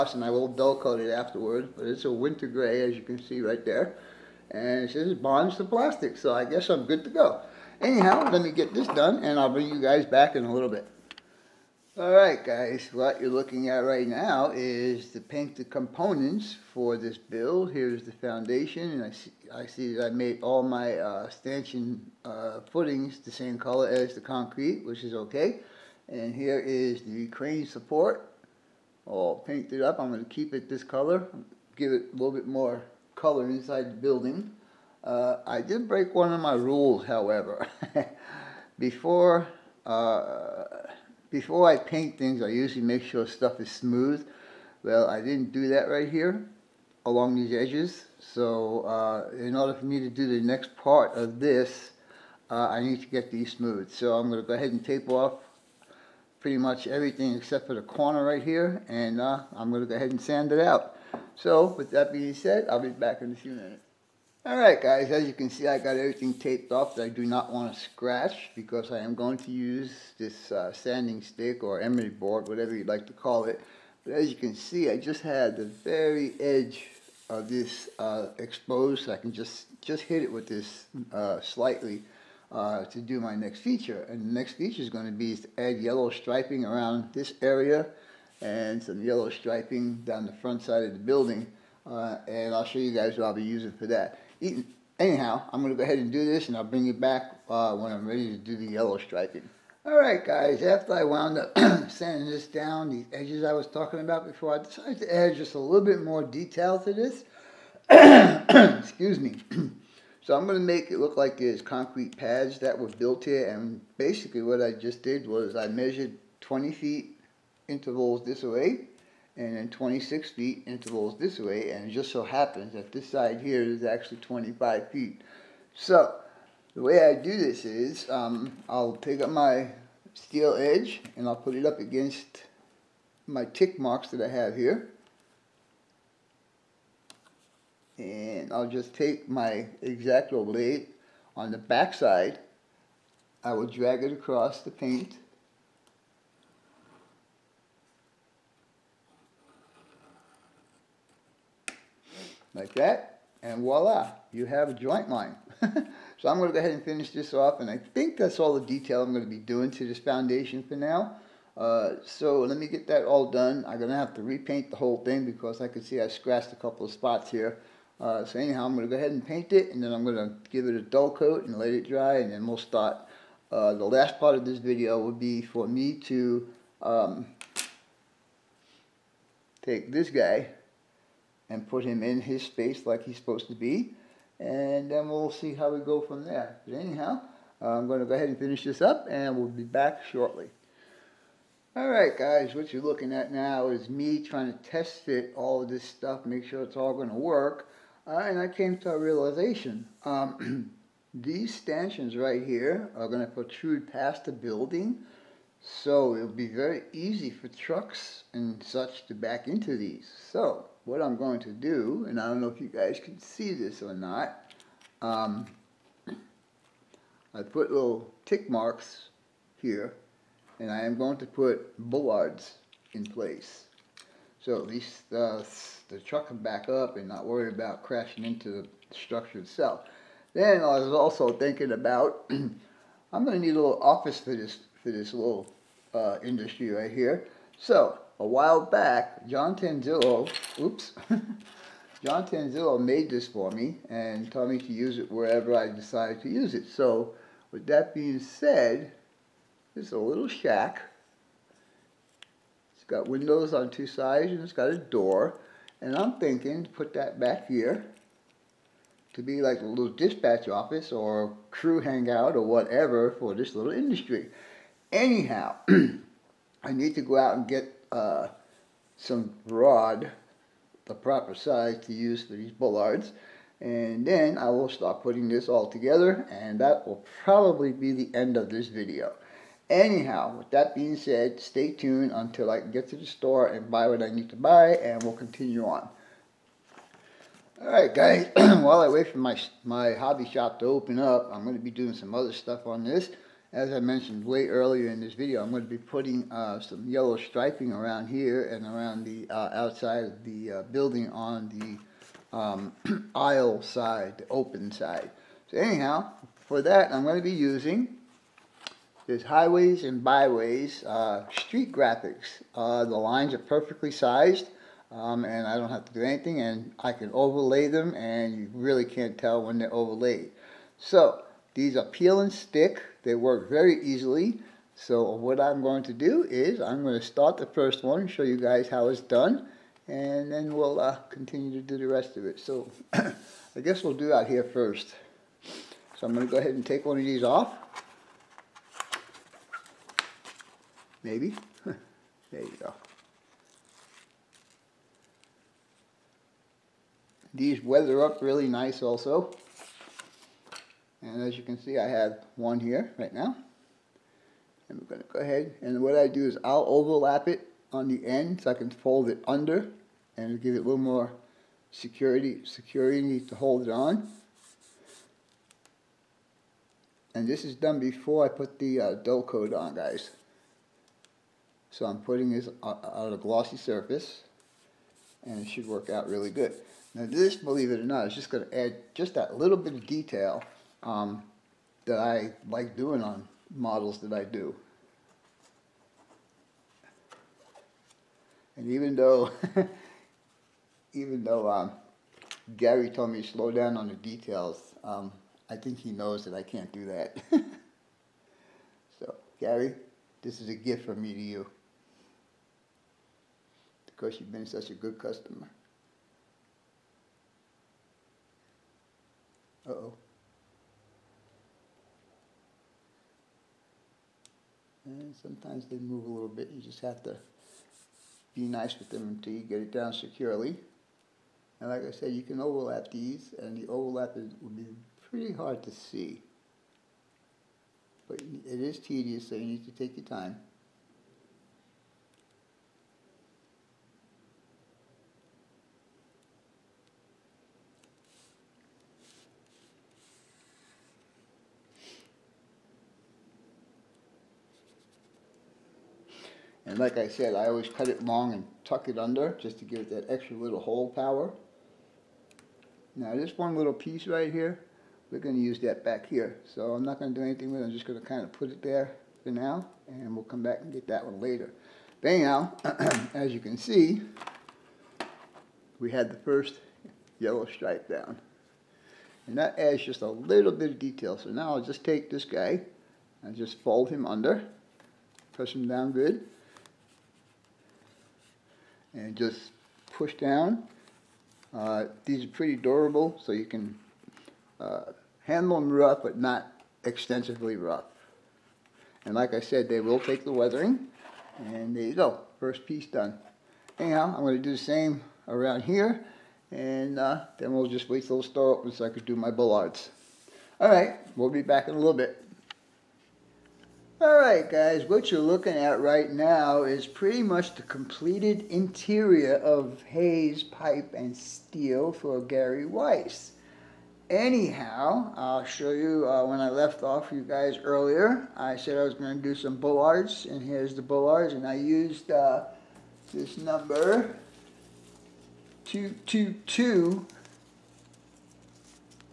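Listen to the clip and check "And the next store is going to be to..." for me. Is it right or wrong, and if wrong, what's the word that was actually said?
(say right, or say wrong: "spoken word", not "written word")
wrong: "feature", not "store".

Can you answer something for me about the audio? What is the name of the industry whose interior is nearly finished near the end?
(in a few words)
Hays Pipe and Steel.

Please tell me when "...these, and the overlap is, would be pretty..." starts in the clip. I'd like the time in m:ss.
7:02.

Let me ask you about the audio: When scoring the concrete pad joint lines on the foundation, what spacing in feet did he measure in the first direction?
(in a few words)
20 feet.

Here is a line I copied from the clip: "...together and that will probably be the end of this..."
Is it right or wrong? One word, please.
right.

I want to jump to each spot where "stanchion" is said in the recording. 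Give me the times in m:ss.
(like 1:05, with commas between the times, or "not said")
0:21, 3:21.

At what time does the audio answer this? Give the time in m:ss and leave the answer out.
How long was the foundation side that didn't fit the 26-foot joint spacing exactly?
2:04.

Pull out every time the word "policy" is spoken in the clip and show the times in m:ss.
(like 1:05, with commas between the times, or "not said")
not said.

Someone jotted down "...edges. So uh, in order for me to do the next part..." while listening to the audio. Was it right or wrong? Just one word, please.
right.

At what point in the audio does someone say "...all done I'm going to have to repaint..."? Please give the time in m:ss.
2:43.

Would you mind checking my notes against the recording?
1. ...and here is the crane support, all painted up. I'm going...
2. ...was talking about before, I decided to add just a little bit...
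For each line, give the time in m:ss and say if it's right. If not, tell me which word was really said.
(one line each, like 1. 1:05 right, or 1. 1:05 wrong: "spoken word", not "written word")
1. 0:26 right
2. 1:43 right.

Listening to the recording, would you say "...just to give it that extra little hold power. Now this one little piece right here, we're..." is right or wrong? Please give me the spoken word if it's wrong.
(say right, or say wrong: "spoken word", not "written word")
right.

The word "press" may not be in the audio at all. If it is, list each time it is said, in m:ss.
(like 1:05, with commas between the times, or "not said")
7:55.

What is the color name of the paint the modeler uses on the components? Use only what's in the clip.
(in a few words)
winter gray.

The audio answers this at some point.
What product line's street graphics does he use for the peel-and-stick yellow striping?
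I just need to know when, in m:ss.
5:09.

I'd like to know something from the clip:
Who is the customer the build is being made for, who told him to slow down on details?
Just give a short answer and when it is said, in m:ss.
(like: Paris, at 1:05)
Gary Weiss, at 8:32.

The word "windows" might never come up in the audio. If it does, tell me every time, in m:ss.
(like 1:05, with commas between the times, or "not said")
4:13.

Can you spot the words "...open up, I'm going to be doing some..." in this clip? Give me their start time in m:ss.
4:50.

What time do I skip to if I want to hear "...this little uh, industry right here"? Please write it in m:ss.
3:54.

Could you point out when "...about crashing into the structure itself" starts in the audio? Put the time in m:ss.
3:47.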